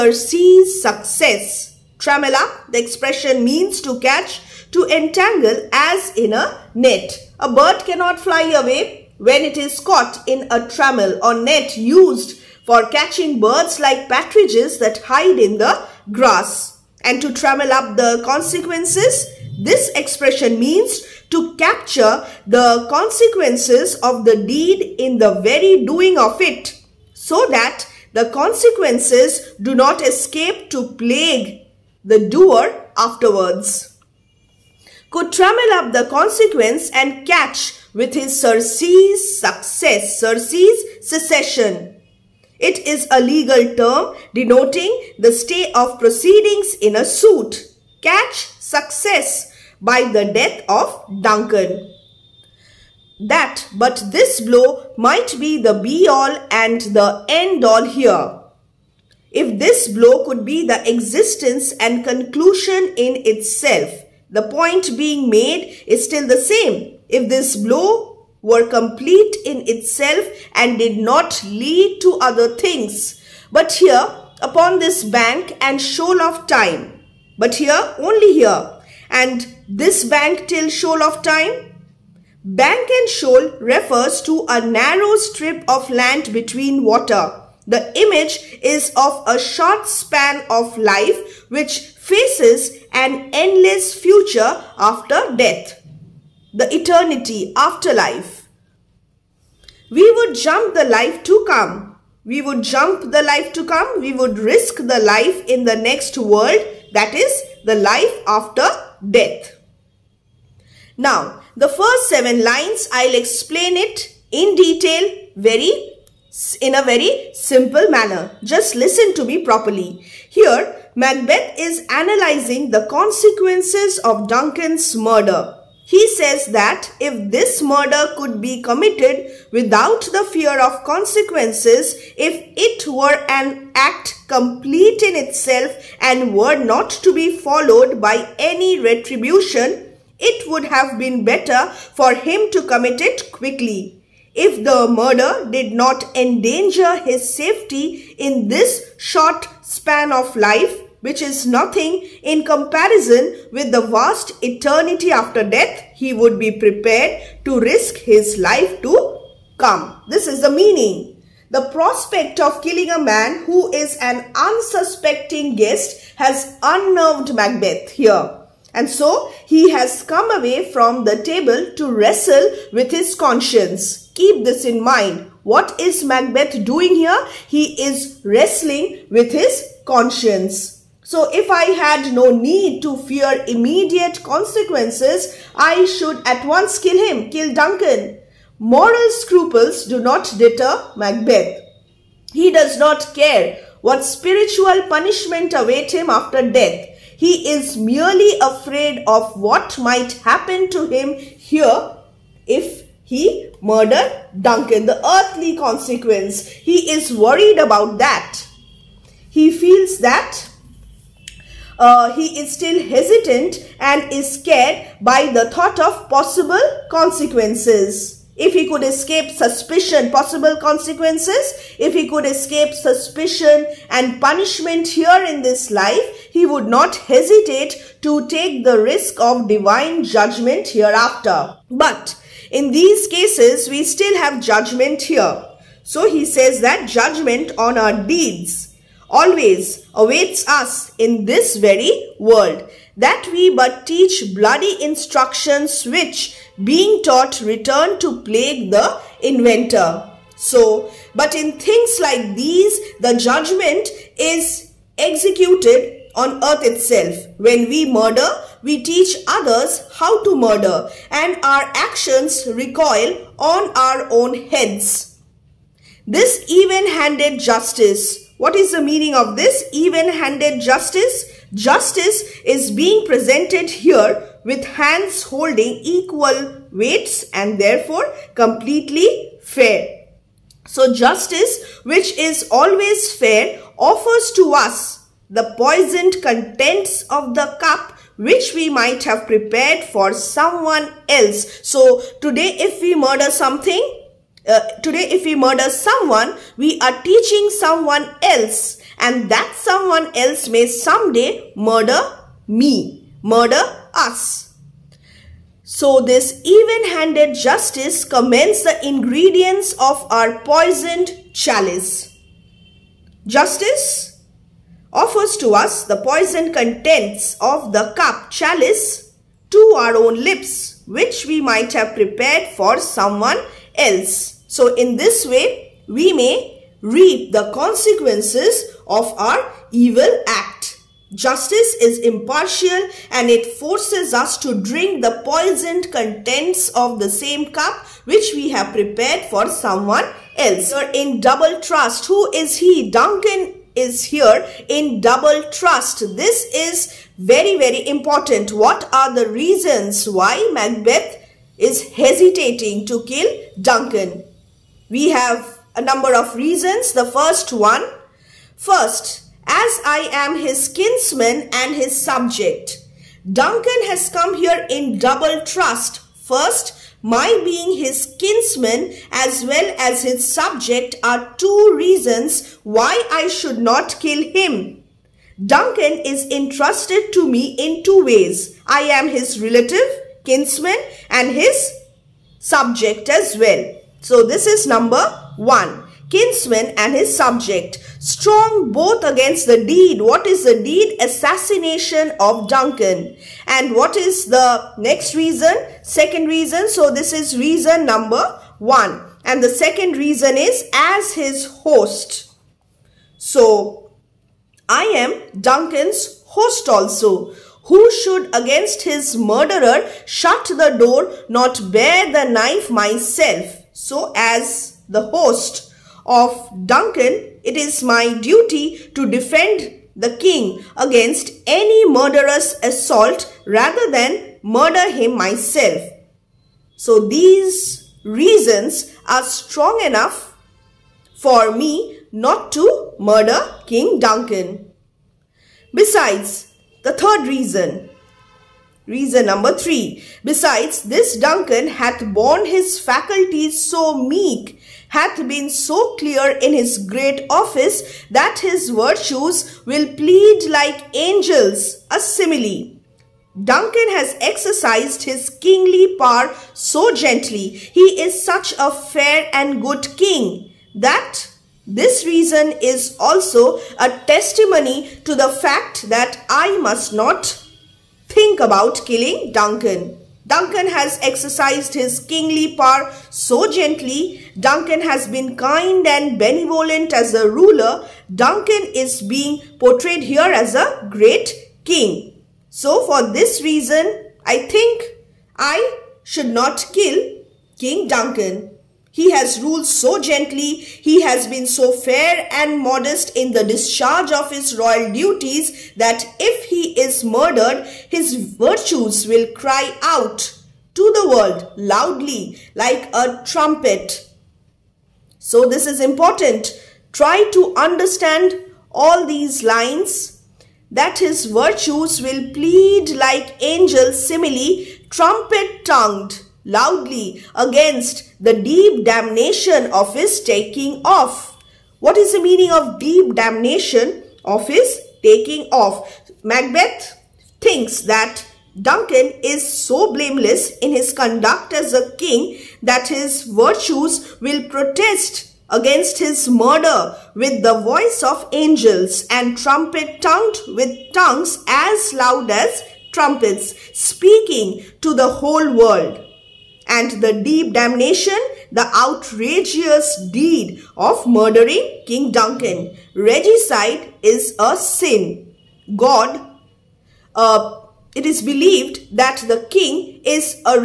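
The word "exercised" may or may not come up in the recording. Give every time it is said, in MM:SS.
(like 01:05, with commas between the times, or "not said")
07:34, 07:51.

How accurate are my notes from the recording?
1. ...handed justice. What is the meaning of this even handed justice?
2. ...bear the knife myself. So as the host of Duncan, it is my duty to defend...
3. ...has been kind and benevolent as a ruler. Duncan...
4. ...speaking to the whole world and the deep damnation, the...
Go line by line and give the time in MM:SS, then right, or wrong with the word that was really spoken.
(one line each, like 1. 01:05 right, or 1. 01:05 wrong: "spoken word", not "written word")
1. 04:26 right
2. 06:51 right
3. 07:54 right
4. 09:03 right.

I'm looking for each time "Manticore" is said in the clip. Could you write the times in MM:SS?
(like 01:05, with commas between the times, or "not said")
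not said.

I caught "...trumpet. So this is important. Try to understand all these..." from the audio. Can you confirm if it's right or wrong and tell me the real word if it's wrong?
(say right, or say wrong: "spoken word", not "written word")
right.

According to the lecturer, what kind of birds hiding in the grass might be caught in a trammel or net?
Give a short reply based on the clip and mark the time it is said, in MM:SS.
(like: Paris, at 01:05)
Partridges, at 00:14.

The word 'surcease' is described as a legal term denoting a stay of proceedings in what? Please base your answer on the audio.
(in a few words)
A suit.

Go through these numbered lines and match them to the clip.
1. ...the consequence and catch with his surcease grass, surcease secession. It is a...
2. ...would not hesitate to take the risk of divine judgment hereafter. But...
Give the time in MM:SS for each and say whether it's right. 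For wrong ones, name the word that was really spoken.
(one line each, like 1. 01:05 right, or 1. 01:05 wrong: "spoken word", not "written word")
1. 00:35 wrong: "success", not "grass"
2. 03:46 right.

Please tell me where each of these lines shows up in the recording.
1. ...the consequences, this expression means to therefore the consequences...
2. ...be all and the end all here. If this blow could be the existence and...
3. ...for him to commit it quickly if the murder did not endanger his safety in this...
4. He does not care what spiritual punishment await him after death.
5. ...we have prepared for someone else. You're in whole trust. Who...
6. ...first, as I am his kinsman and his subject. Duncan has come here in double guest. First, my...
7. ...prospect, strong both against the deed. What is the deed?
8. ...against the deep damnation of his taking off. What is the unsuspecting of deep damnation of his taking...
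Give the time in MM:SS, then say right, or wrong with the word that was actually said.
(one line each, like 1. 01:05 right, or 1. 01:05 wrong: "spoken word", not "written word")
1. 00:17 wrong: "capture", not "therefore"
2. 00:55 right
3. 02:21 right
4. 03:12 right
5. 05:38 wrong: "double", not "whole"
6. 05:58 wrong: "trust", not "guest"
7. 06:27 wrong: "subject", not "prospect"
8. 08:37 wrong: "meaning", not "unsuspecting".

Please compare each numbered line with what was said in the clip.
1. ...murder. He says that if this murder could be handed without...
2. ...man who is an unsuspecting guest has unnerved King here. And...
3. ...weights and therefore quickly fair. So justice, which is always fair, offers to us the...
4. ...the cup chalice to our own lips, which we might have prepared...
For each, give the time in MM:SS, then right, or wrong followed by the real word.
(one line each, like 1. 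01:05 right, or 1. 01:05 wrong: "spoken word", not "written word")
1. 02:04 wrong: "committed", not "handed"
2. 02:43 wrong: "Macbeth", not "King"
3. 04:36 wrong: "completely", not "quickly"
4. 05:17 right.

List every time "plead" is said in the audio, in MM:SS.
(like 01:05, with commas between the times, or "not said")
07:29, 08:32.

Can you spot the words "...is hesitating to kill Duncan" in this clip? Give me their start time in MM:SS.
05:51.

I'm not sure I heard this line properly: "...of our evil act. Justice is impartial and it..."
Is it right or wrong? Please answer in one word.
right.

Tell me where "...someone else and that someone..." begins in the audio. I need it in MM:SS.
04:57.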